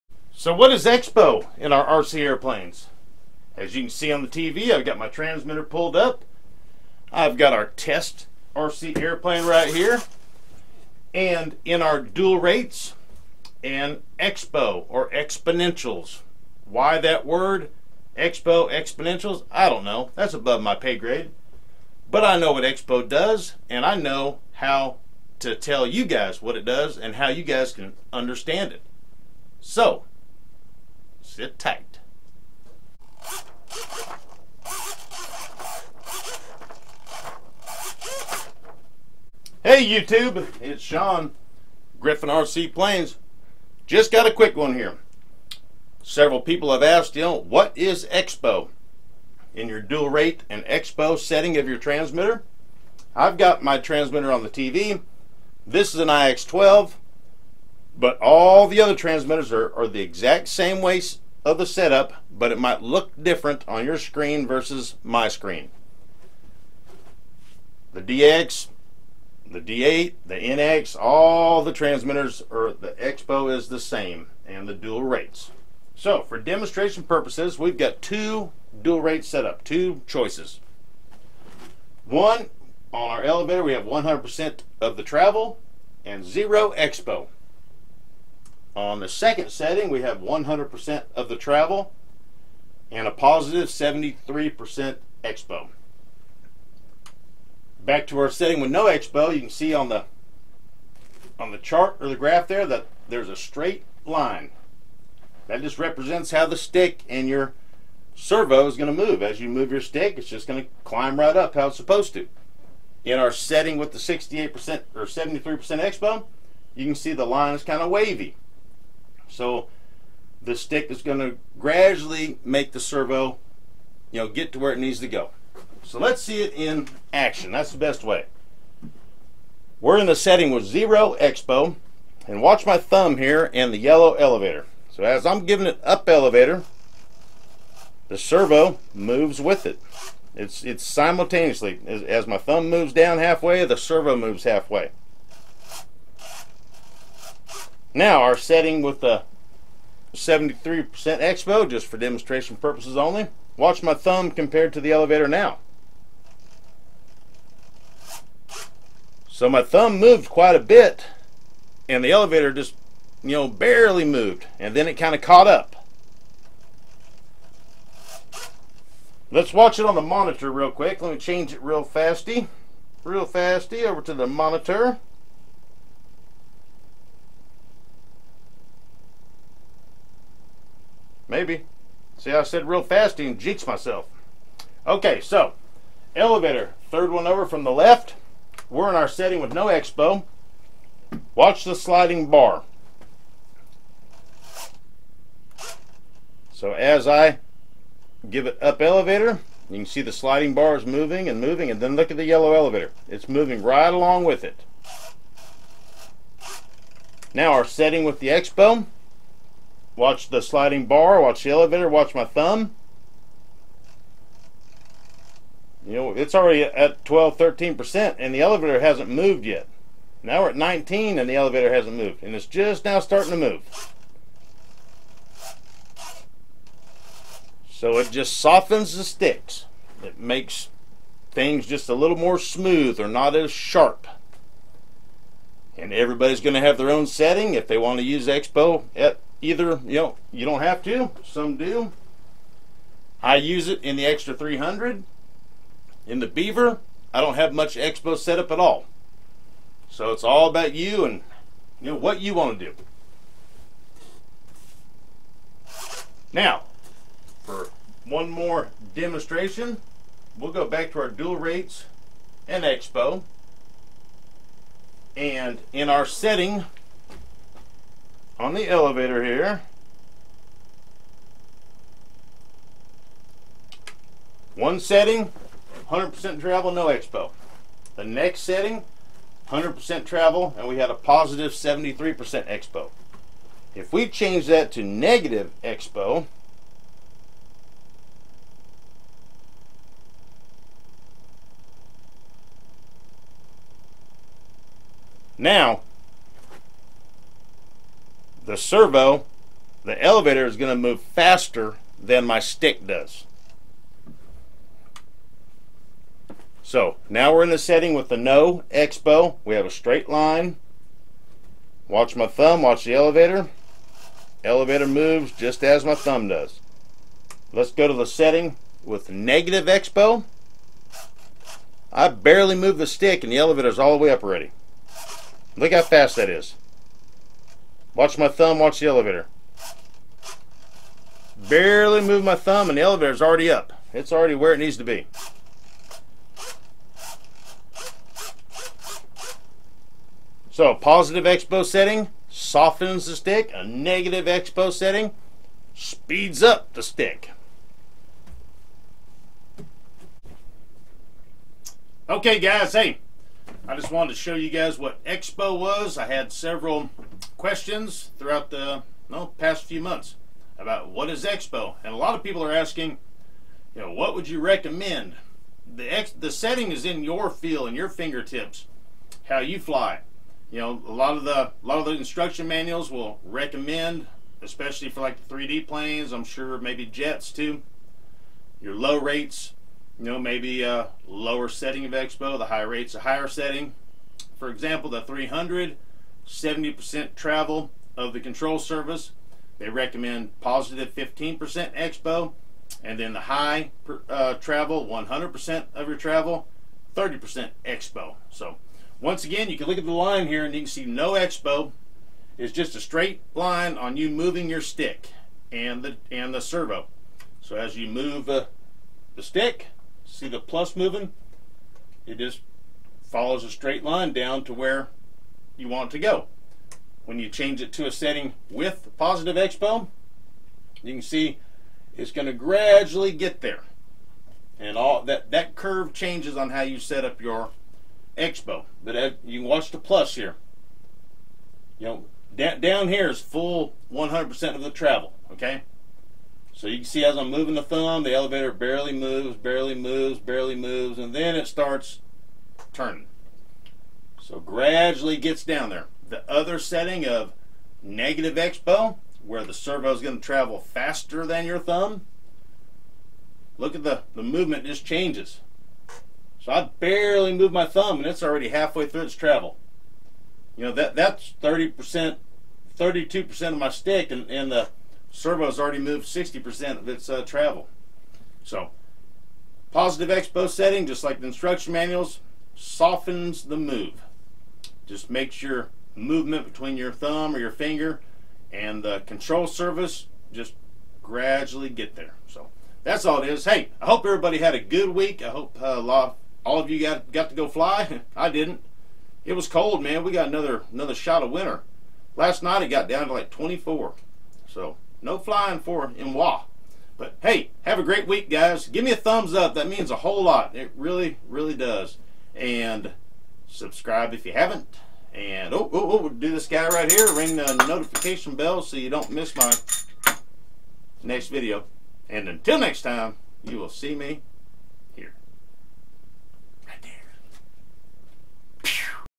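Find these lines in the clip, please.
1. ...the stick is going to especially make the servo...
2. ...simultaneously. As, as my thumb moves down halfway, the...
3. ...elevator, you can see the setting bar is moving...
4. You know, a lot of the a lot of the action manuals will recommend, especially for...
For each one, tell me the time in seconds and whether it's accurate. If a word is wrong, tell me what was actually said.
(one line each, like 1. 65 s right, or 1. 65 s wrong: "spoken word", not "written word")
1. 120 s wrong: "gradually", not "especially"
2. 140 s right
3. 198 s wrong: "sliding", not "setting"
4. 370 s wrong: "instruction", not "action".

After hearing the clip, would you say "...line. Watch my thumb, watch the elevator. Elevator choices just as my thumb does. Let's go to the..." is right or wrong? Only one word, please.
wrong.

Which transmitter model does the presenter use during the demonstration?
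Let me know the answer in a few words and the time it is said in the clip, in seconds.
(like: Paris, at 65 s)
IX12, at 56 s.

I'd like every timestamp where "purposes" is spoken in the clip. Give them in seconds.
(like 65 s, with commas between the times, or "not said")
77 s, 152 s.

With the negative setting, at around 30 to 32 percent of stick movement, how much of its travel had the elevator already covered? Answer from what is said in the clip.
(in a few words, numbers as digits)
60%.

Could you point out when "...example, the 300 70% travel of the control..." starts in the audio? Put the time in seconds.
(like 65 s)
384 s.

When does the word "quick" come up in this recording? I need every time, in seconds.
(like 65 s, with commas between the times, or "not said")
44 s, 170 s.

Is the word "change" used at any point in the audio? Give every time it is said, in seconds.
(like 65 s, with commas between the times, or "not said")
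171 s, 284 s, 417 s, 425 s, 454 s.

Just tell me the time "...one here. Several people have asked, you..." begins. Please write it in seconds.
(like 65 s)
44 s.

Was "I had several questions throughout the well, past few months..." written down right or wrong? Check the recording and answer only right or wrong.
right.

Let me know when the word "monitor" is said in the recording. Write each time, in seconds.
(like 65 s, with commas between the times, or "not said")
170 s, 174 s.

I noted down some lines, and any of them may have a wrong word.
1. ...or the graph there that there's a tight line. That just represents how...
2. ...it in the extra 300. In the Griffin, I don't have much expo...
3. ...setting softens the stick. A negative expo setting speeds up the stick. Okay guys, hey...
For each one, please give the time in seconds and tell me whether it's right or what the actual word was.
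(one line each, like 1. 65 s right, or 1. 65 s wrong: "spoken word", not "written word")
1. 101 s wrong: "straight", not "tight"
2. 243 s wrong: "Beaver", not "Griffin"
3. 341 s right.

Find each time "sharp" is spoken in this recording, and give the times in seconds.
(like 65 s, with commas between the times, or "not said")
233 s.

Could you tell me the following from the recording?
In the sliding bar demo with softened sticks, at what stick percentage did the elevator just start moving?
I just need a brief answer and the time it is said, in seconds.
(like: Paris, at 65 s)
19, at 220 s.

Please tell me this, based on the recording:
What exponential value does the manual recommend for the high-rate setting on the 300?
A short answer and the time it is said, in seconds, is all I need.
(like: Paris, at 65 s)
30%, at 396 s.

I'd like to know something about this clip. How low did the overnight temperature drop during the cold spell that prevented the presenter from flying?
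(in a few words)
24.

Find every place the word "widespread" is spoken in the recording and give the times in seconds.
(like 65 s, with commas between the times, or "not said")
not said.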